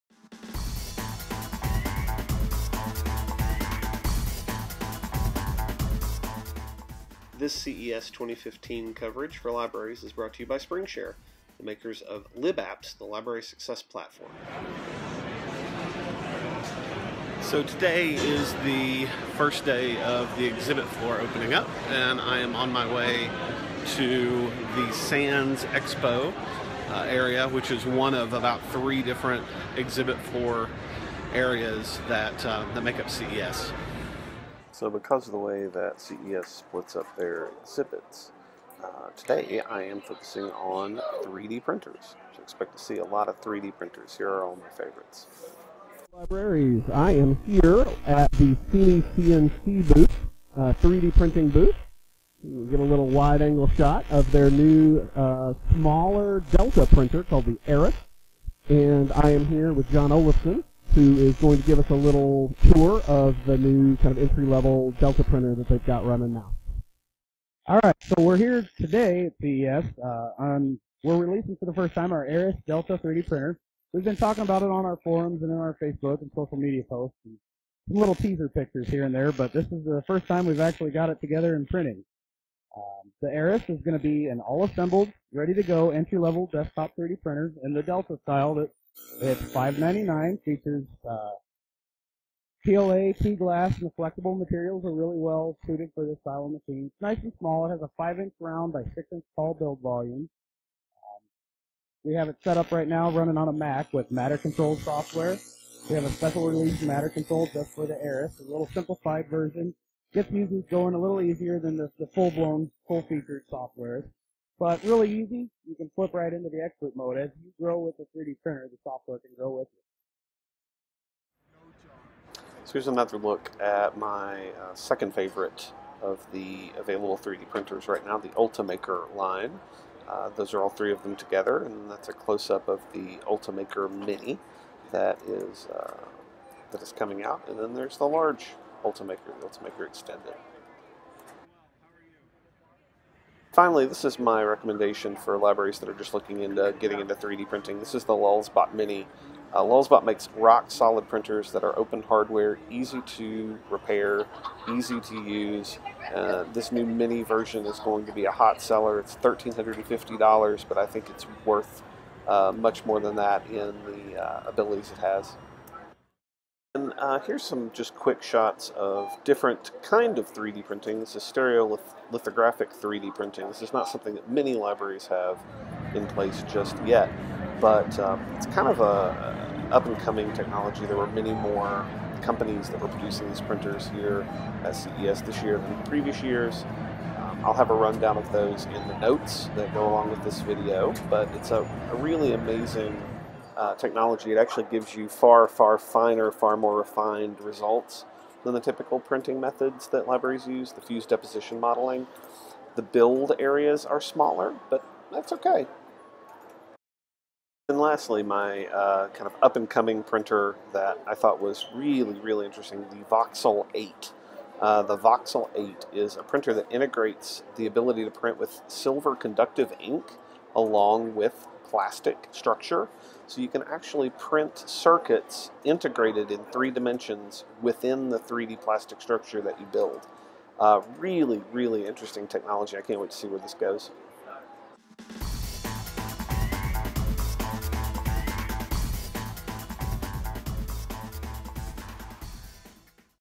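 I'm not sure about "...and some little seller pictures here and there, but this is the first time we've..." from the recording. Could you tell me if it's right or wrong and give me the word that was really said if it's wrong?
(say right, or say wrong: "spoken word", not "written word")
wrong: "teaser", not "seller".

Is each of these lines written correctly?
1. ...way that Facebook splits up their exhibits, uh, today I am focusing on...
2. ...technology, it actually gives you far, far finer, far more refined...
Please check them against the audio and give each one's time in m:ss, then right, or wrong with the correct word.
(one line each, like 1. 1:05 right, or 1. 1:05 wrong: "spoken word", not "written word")
1. 0:35 wrong: "CES", not "Facebook"
2. 3:13 right.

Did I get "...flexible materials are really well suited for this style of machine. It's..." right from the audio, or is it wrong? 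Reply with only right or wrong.
right.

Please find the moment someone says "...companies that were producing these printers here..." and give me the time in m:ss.
3:02.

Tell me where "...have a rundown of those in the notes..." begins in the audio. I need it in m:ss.
3:07.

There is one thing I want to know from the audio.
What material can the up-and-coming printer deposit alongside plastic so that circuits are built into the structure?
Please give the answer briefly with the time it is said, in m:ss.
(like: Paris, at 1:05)
silver conductive ink, at 3:38.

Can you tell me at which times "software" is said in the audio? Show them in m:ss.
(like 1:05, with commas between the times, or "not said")
1:44, 1:53, 1:58.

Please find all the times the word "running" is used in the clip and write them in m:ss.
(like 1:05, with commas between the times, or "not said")
1:06, 1:43.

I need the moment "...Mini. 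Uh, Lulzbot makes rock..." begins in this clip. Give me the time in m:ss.
2:28.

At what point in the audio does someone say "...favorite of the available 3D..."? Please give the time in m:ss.
2:05.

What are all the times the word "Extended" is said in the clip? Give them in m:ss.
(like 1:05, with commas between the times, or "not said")
2:19.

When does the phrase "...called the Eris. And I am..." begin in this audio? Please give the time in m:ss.
0:57.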